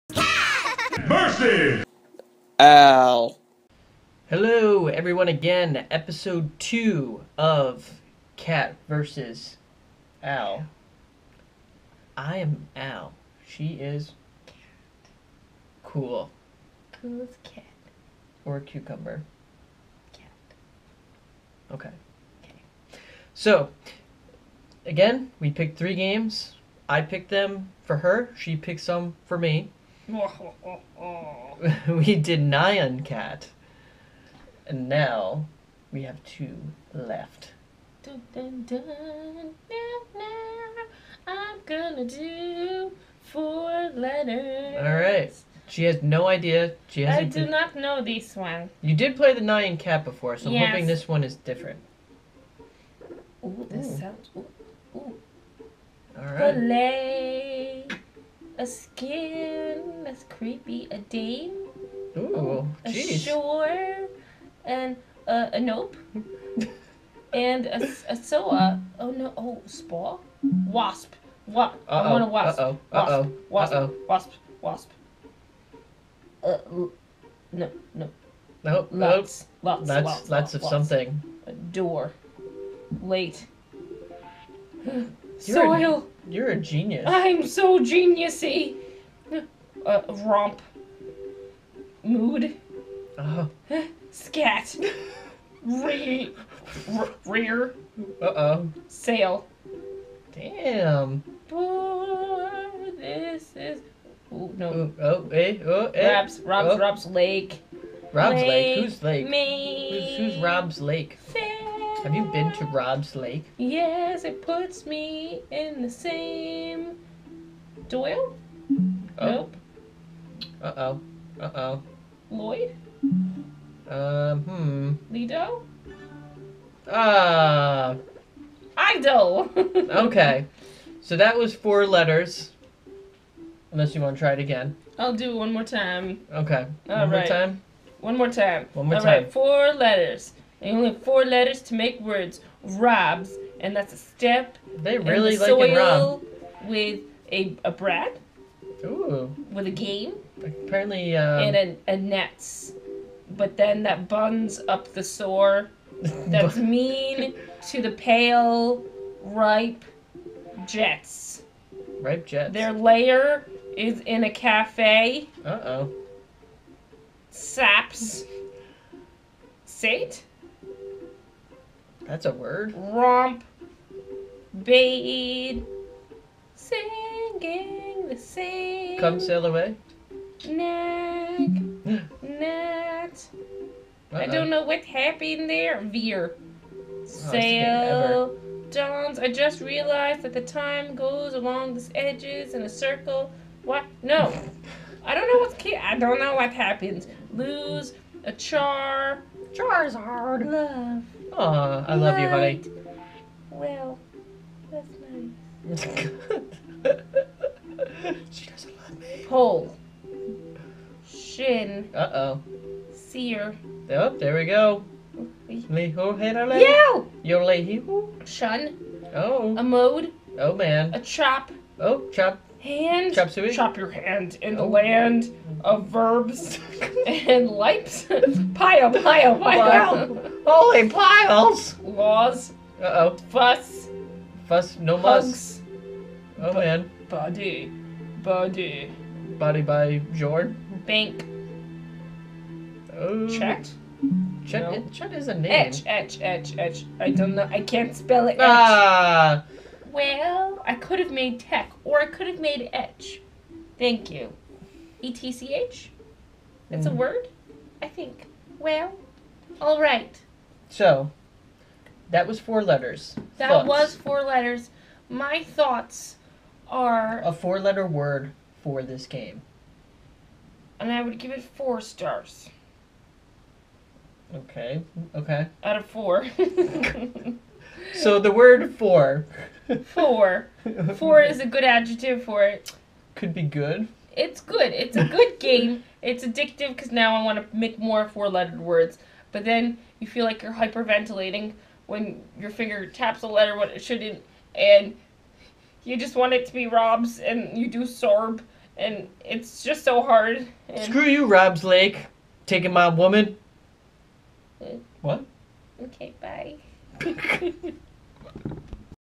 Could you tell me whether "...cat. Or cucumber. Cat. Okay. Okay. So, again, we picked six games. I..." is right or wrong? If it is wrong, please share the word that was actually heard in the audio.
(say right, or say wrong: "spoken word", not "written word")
wrong: "three", not "six".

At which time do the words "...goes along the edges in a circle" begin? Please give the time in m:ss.
3:10.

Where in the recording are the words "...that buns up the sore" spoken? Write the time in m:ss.
2:33.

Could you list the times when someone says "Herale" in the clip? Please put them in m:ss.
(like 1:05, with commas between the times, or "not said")
3:36.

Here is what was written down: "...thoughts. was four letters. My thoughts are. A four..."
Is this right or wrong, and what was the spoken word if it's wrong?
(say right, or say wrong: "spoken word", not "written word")
right.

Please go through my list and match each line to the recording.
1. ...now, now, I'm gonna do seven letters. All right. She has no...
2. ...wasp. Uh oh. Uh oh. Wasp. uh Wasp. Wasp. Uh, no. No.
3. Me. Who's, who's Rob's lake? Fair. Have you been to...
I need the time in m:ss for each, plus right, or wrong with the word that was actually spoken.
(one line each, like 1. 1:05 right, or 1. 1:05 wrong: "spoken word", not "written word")
1. 0:38 wrong: "four", not "seven"
2. 1:12 right
3. 1:49 right.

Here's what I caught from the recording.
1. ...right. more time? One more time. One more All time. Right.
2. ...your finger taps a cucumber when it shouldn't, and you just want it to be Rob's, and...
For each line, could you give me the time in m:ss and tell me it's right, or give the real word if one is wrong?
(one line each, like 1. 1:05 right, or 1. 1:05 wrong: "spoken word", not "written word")
1. 2:17 right
2. 4:52 wrong: "letter", not "cucumber".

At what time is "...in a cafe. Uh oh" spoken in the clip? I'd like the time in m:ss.
2:44.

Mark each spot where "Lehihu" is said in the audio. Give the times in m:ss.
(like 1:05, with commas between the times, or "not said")
3:37.